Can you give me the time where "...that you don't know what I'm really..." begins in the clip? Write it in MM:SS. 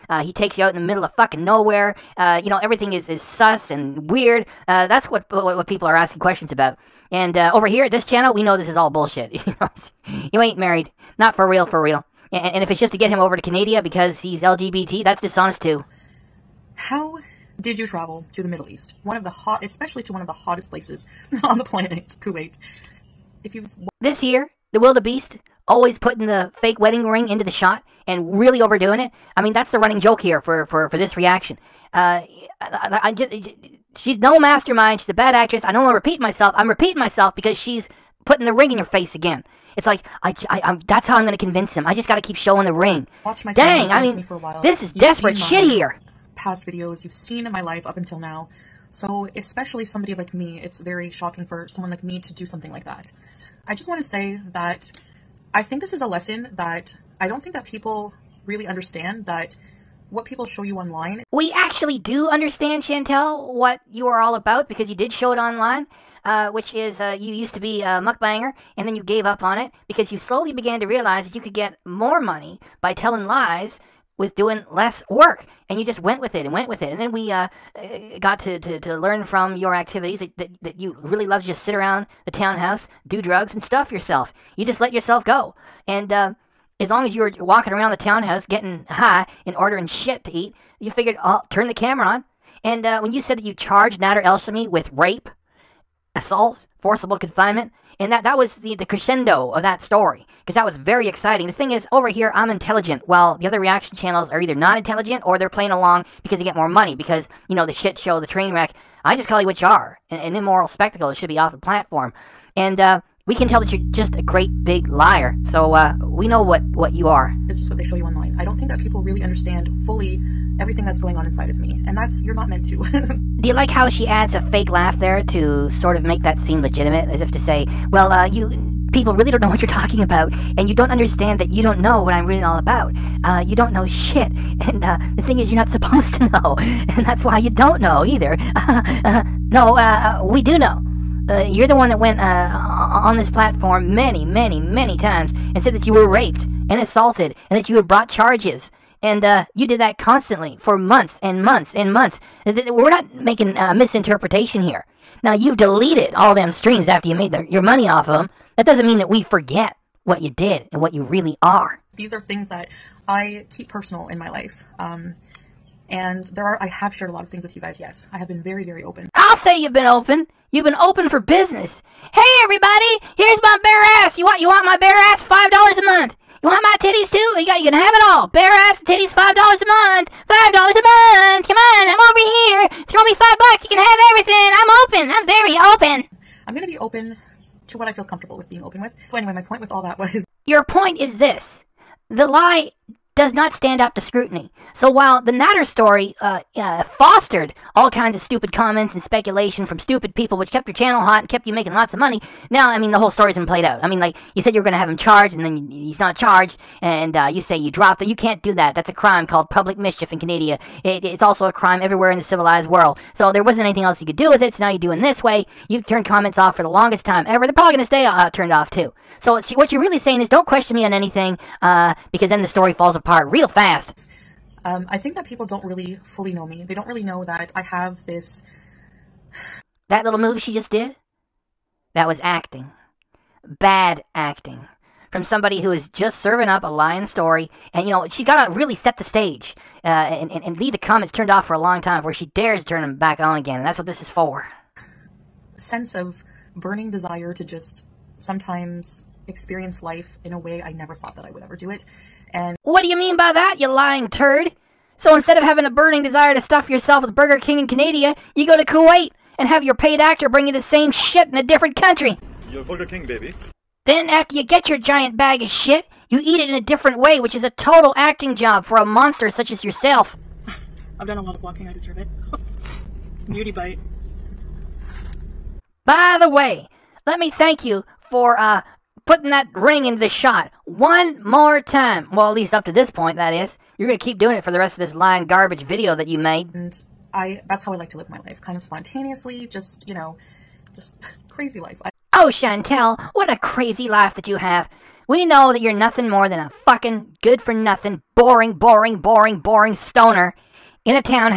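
02:11.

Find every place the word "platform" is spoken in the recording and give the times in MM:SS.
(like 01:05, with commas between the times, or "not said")
01:51, 02:23.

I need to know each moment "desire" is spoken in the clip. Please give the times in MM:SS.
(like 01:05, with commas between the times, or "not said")
04:06, 04:16.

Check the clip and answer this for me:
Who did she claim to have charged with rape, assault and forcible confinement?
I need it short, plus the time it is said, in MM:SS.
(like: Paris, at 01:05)
Nader Elshami, at 01:33.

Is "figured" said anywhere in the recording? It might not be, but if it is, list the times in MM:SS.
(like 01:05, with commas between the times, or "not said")
01:30.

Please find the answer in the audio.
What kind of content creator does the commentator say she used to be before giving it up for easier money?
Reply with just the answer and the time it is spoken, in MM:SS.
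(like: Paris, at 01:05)
mukbanger, at 01:08.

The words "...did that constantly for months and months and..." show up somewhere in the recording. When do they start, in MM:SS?
02:29.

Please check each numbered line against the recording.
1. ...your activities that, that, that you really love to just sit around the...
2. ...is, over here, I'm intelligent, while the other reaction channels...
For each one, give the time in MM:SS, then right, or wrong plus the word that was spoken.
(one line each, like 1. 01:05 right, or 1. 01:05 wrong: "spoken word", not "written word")
1. 01:19 right
2. 01:41 right.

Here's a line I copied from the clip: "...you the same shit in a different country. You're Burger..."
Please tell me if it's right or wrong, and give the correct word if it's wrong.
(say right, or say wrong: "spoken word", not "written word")
right.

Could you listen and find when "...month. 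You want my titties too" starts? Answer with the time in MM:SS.
02:55.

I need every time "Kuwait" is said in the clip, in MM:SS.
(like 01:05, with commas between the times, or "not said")
00:22, 04:18.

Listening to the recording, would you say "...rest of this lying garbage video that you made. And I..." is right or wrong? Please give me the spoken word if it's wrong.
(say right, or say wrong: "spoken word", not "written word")
right.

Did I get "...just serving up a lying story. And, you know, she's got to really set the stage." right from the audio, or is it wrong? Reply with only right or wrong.
right.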